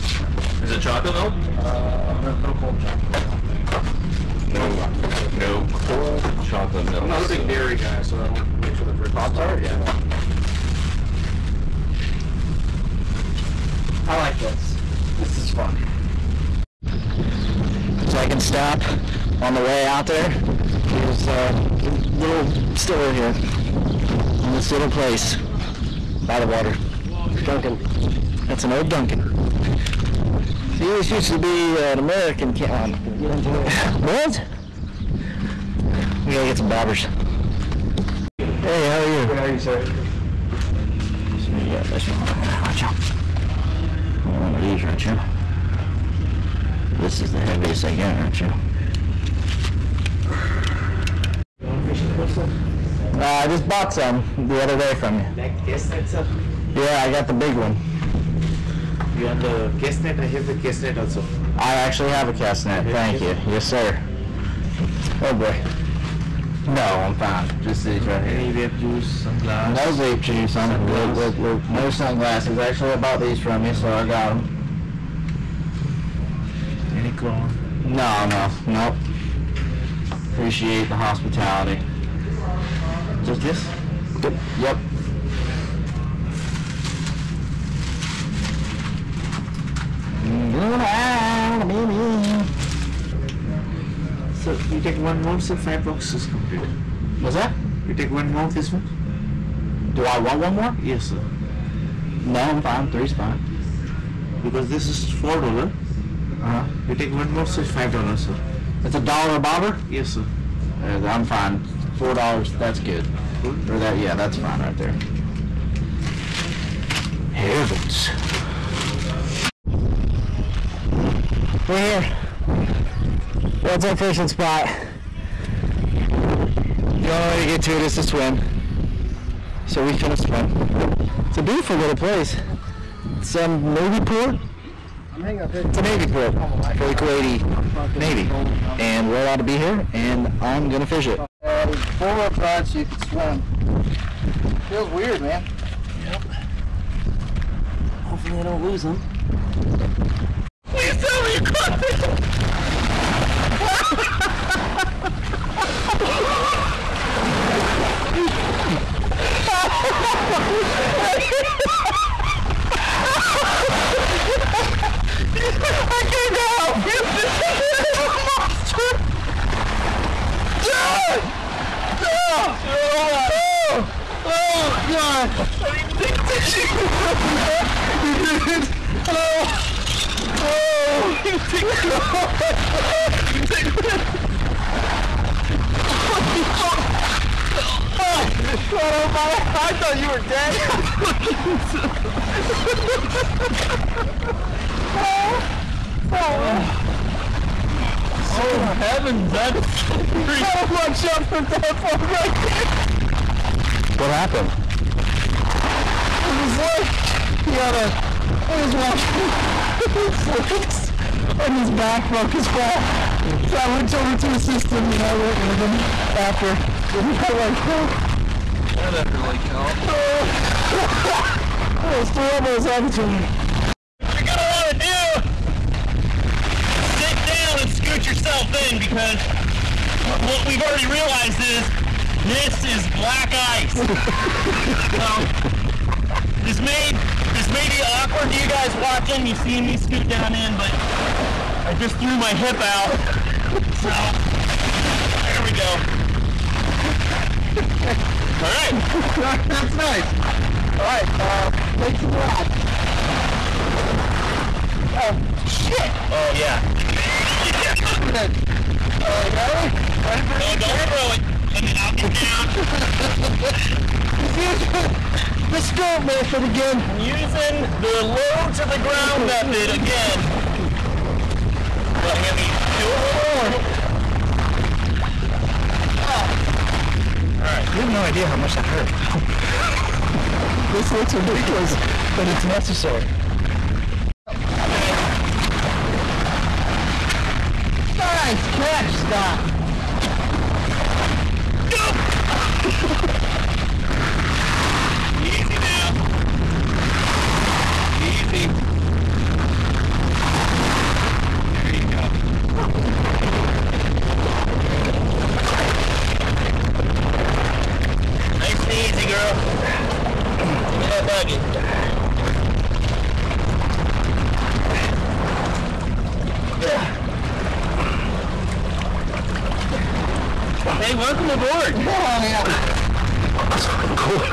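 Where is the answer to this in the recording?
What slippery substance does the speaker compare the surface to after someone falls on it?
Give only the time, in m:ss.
3:52.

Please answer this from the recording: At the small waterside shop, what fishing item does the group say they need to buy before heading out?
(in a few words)
Bobbers.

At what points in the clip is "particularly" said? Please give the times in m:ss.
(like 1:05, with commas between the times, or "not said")
not said.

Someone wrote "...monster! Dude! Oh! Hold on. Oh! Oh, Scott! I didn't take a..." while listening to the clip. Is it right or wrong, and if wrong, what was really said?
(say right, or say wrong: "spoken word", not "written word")
wrong: "God", not "Scott".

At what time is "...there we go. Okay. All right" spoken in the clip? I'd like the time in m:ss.
4:05.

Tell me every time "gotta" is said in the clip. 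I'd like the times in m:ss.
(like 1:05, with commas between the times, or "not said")
0:36, 3:20.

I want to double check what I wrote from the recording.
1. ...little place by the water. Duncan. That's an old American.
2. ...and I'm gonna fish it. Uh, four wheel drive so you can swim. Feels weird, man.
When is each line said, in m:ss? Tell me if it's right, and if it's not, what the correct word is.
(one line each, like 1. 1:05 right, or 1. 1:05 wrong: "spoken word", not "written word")
1. 0:24 wrong: "Duncan", not "American"
2. 2:19 right.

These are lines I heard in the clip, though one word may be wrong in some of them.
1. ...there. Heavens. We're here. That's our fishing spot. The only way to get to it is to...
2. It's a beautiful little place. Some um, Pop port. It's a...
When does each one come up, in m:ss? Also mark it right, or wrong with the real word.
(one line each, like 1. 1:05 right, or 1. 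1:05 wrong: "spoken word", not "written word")
1. 1:54 right
2. 2:11 wrong: "Navy", not "Pop".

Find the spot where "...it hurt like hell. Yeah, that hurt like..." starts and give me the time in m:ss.
3:37.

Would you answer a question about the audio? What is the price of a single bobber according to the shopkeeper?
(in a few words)
1 dollar.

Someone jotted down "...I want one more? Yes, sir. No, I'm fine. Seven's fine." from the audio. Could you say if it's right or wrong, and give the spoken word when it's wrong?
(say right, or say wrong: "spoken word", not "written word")
wrong: "Three", not "Seven".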